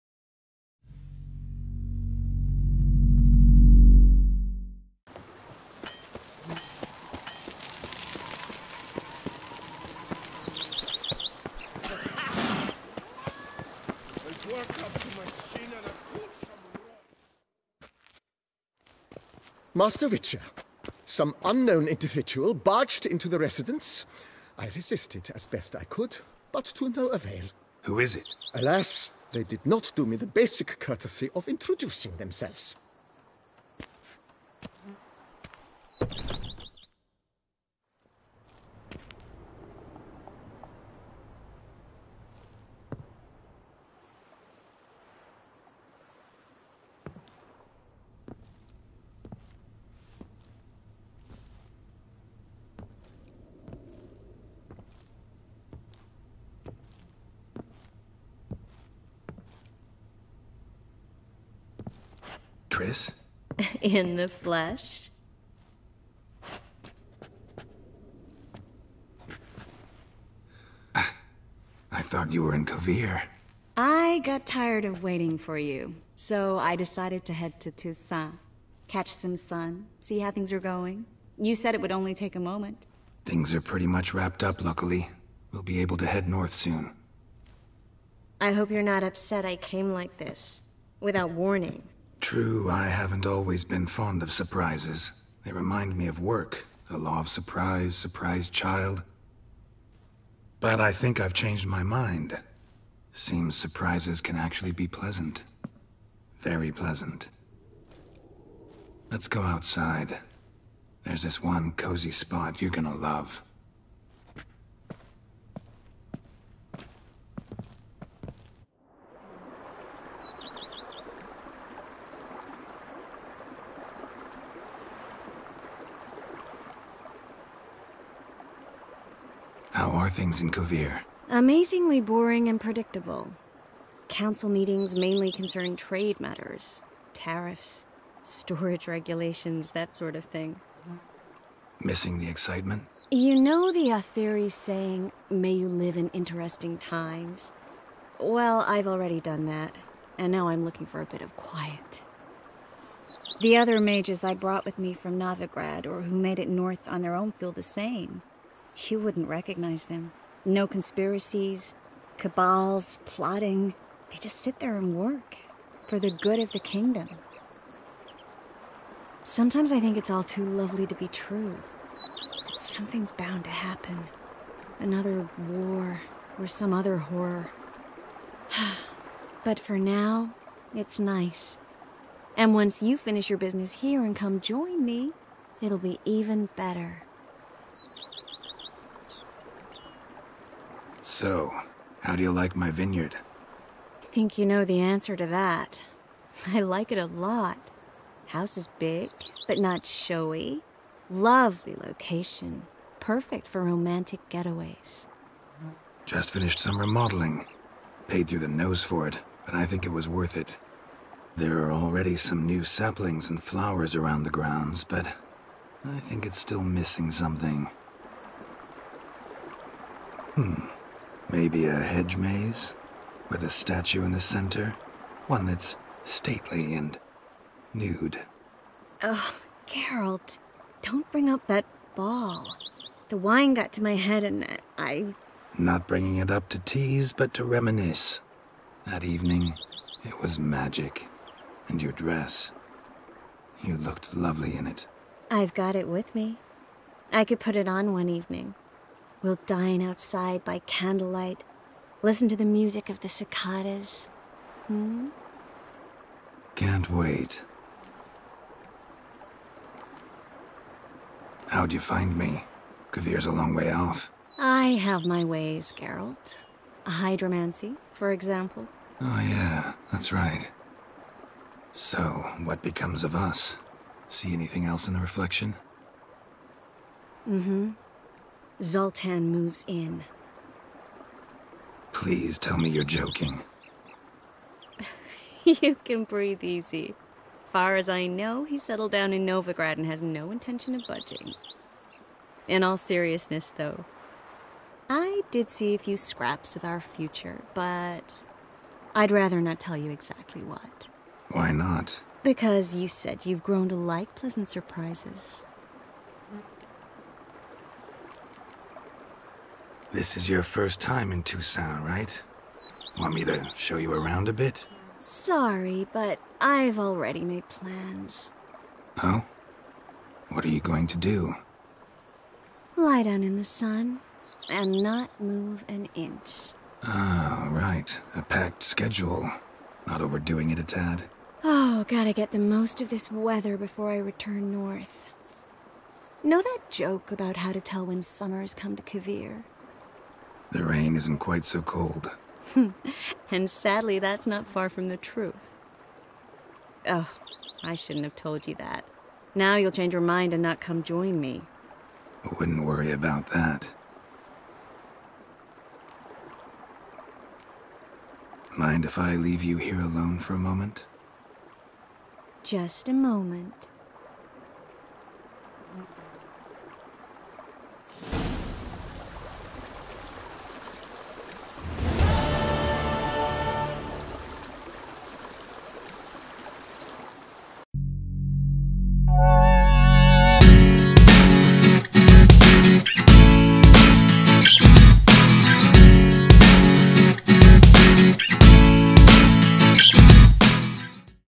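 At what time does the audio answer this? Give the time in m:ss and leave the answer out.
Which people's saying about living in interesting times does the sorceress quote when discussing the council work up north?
2:23.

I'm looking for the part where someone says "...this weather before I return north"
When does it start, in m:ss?
5:32.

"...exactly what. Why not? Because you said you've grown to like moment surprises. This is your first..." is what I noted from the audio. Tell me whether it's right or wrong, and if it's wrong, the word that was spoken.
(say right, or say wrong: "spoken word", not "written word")
wrong: "pleasant", not "moment".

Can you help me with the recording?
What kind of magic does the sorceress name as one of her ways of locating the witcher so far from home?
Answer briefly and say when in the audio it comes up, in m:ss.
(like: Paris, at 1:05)
Hydromancy, at 4:26.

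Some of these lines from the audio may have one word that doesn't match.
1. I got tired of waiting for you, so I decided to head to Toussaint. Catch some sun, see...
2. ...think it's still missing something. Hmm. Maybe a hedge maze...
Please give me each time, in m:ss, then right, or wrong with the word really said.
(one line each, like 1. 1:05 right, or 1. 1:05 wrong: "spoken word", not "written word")
1. 1:13 right
2. 3:35 right.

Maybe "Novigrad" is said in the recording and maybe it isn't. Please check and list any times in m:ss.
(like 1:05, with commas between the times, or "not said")
2:35, 4:49.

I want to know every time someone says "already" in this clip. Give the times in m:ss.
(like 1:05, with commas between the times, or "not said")
2:28, 3:31, 5:16.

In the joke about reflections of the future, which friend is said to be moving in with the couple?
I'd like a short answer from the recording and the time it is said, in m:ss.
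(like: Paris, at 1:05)
Zoltan, at 4:38.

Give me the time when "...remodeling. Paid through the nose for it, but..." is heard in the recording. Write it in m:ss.
3:26.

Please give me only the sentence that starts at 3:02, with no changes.
And once you finish your business here and come join me, it'll be even better.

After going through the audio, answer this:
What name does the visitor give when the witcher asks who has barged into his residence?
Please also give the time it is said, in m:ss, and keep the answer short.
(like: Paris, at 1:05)
Triss, at 1:02.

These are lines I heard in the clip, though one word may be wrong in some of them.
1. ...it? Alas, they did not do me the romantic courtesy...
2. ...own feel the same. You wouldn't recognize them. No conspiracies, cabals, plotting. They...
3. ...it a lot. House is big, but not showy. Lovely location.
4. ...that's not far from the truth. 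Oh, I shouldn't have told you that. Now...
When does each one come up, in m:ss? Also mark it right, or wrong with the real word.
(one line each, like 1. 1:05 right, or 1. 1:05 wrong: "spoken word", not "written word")
1. 0:28 wrong: "basic", not "romantic"
2. 2:37 right
3. 3:16 right
4. 5:43 right.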